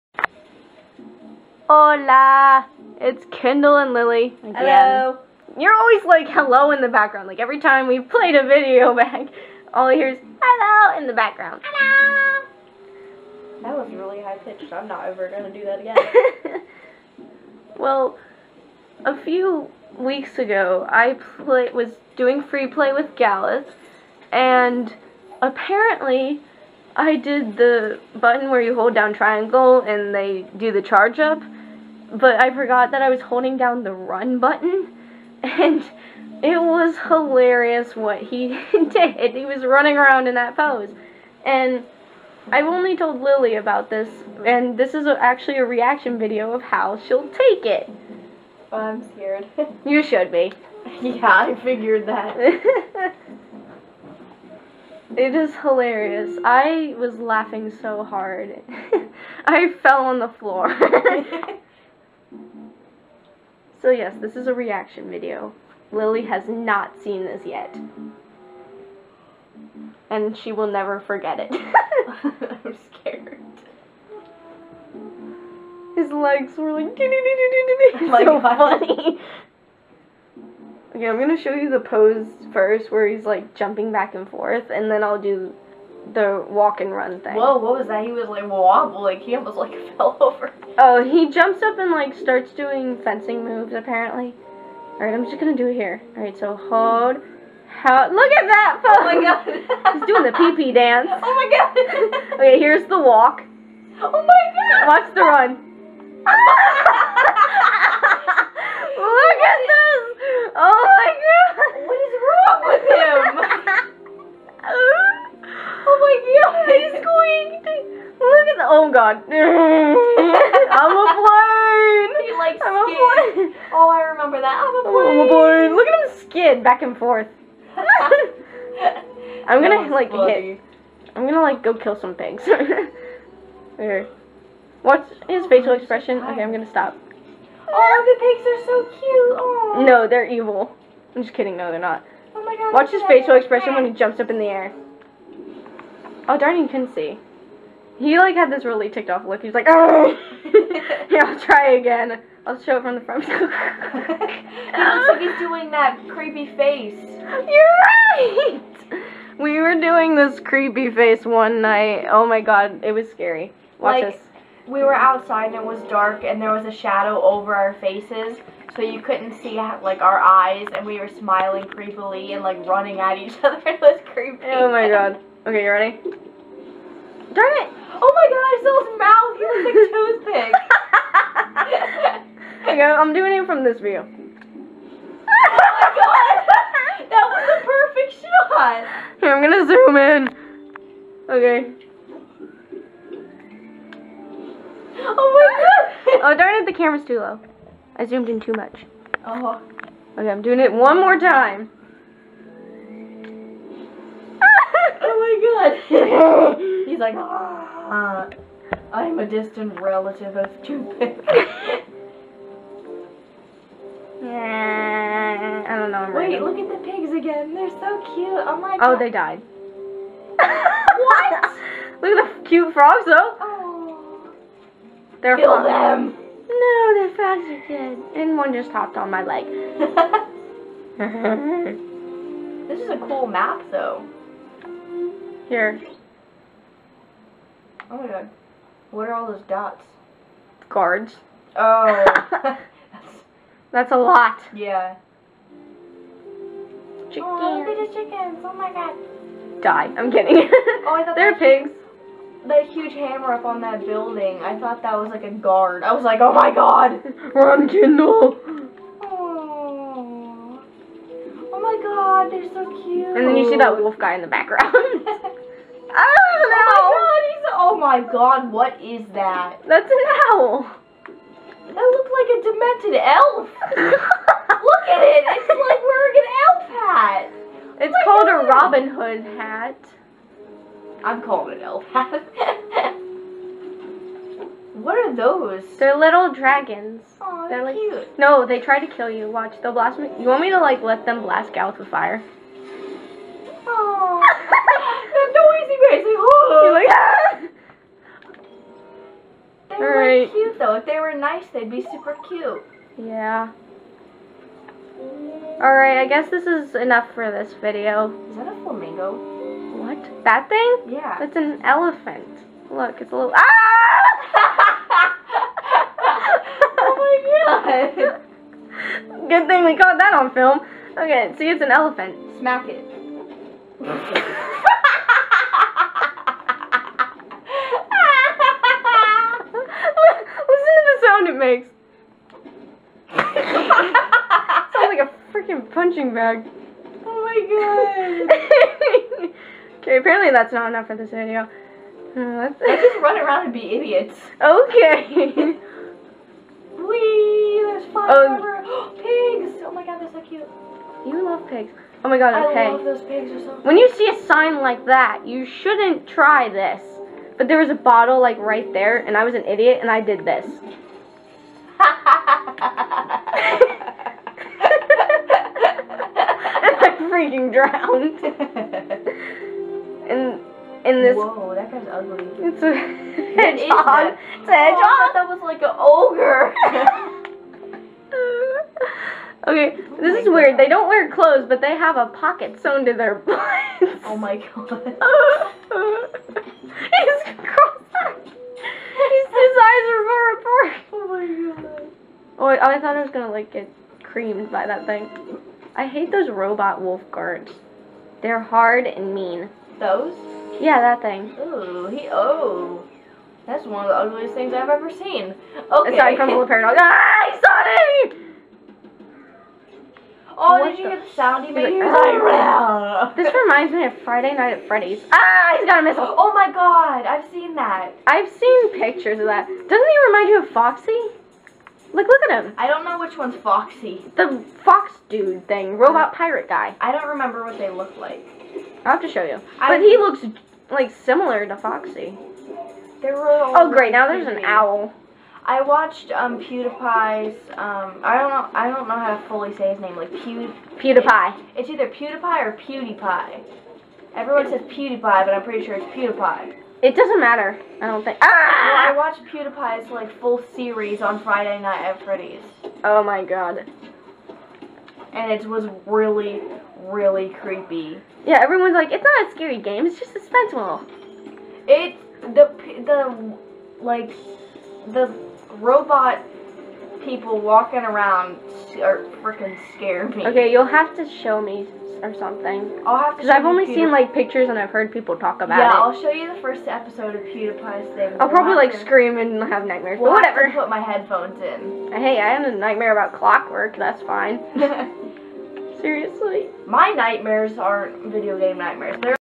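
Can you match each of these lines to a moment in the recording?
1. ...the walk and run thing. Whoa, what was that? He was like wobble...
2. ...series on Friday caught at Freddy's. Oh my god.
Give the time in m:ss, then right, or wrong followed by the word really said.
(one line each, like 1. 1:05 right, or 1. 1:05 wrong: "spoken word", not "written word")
1. 1:26 right
2. 7:30 wrong: "night", not "caught".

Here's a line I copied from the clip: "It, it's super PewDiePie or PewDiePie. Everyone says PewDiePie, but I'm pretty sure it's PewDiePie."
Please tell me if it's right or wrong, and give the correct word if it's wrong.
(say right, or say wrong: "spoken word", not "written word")
wrong: "either", not "super".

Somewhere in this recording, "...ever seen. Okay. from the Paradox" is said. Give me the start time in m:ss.
6:44.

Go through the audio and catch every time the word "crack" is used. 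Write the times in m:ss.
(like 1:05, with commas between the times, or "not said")
not said.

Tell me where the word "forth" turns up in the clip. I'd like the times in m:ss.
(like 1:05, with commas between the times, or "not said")
1:24, 2:06.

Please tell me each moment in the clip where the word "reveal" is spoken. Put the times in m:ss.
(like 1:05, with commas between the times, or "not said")
not said.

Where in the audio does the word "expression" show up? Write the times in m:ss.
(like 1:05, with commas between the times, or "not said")
2:15, 2:23.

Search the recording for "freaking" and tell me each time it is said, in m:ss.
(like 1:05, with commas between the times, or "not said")
5:35, 6:07, 7:49.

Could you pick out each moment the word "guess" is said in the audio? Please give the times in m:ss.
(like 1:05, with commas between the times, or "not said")
5:06.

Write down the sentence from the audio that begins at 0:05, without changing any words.
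You're always like hello in the background.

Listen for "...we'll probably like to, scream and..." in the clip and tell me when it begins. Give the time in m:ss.
7:58.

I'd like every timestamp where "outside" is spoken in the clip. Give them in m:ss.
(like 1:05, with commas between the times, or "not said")
2:44.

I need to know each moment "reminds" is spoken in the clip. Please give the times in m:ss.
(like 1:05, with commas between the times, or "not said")
6:53, 7:00.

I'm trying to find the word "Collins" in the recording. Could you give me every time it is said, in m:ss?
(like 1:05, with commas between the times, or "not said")
not said.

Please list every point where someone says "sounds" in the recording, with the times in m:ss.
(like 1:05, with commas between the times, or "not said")
5:33, 6:51.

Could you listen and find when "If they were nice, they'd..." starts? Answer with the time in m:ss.
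5:00.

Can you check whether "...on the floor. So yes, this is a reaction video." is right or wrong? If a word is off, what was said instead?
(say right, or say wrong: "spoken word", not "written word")
right.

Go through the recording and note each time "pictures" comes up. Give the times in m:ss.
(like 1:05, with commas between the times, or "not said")
6:58, 7:54.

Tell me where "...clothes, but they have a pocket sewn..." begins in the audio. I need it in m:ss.
6:21.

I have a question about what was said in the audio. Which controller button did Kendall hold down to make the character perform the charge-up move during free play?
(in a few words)
Triangle.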